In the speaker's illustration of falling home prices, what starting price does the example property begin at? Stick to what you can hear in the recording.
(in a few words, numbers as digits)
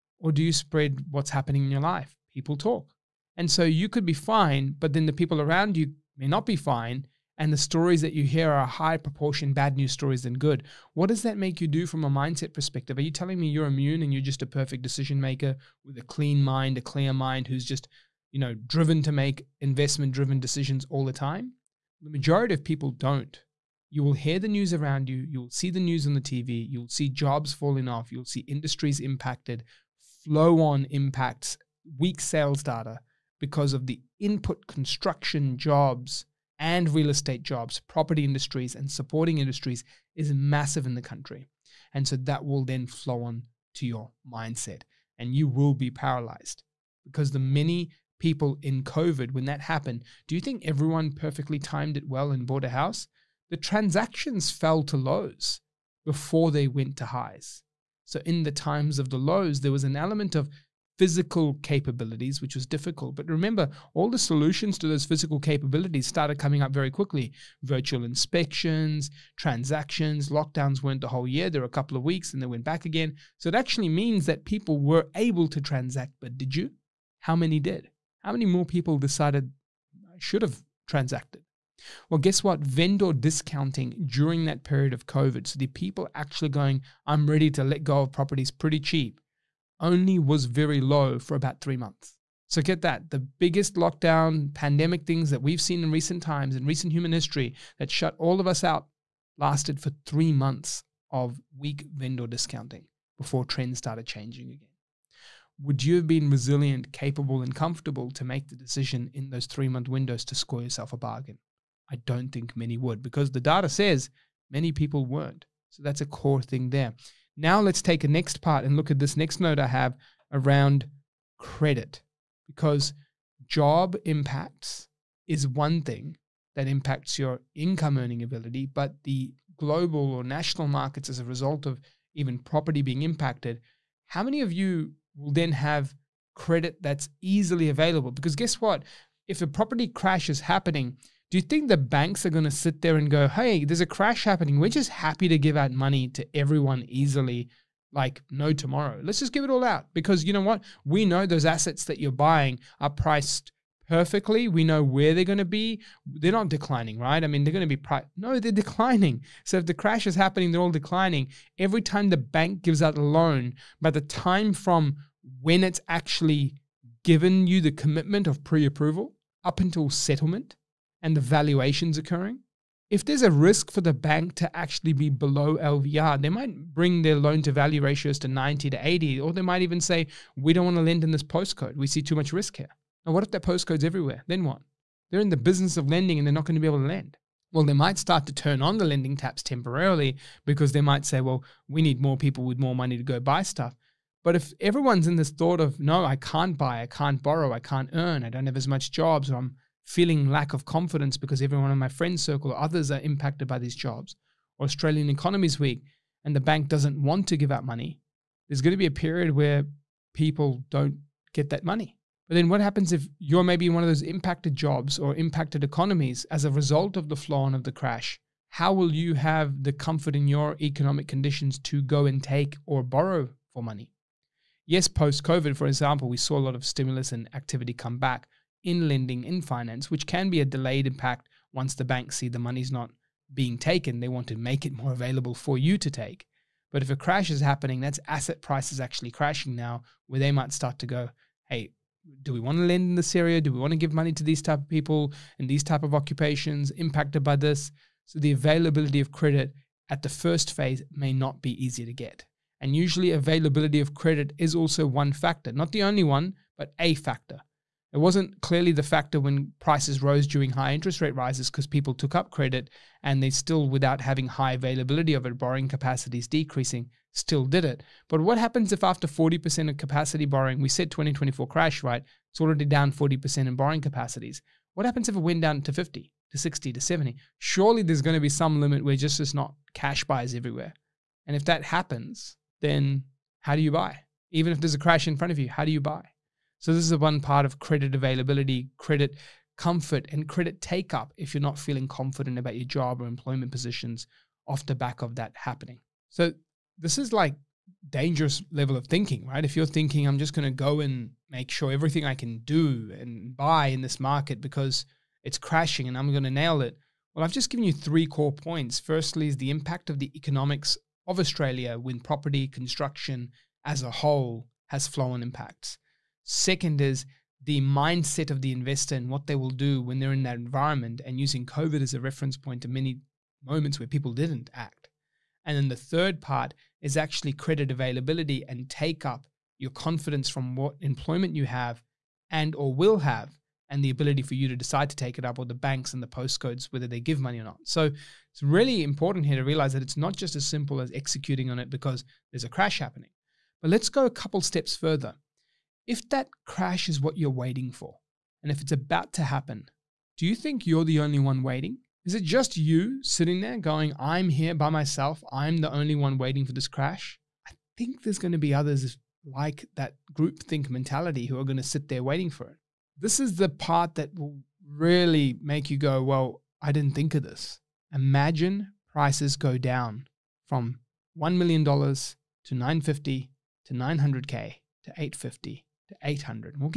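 $1 million.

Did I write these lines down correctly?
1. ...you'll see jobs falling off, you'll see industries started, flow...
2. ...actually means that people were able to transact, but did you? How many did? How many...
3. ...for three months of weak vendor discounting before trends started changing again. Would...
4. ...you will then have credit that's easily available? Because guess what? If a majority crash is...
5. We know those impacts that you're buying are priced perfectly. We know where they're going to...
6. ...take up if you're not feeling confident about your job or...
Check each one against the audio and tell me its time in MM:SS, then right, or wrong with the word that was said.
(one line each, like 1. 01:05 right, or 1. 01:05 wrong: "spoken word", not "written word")
1. 00:26 wrong: "impacted", not "started"
2. 01:13 right
3. 01:39 right
4. 02:14 wrong: "property", not "majority"
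5. 02:30 wrong: "assets", not "impacts"
6. 04:50 right.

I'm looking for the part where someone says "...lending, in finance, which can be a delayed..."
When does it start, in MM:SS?
03:48.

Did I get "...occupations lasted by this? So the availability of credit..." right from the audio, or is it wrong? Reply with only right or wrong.
wrong.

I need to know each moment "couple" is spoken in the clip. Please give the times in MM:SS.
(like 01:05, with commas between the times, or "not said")
01:11, 05:44.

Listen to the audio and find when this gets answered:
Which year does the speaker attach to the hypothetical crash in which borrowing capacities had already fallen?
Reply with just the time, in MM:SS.
04:30.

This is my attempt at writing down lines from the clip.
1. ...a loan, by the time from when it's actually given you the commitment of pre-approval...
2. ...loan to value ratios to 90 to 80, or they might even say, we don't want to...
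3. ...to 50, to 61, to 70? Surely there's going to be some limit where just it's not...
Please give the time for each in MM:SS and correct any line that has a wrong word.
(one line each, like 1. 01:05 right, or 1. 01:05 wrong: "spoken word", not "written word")
1. 02:42 right
2. 02:57 right
3. 04:35 wrong: "60", not "61".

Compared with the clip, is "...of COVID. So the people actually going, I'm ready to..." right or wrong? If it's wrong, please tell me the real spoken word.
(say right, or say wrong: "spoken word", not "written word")
right.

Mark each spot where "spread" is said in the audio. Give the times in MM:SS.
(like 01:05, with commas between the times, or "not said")
00:00.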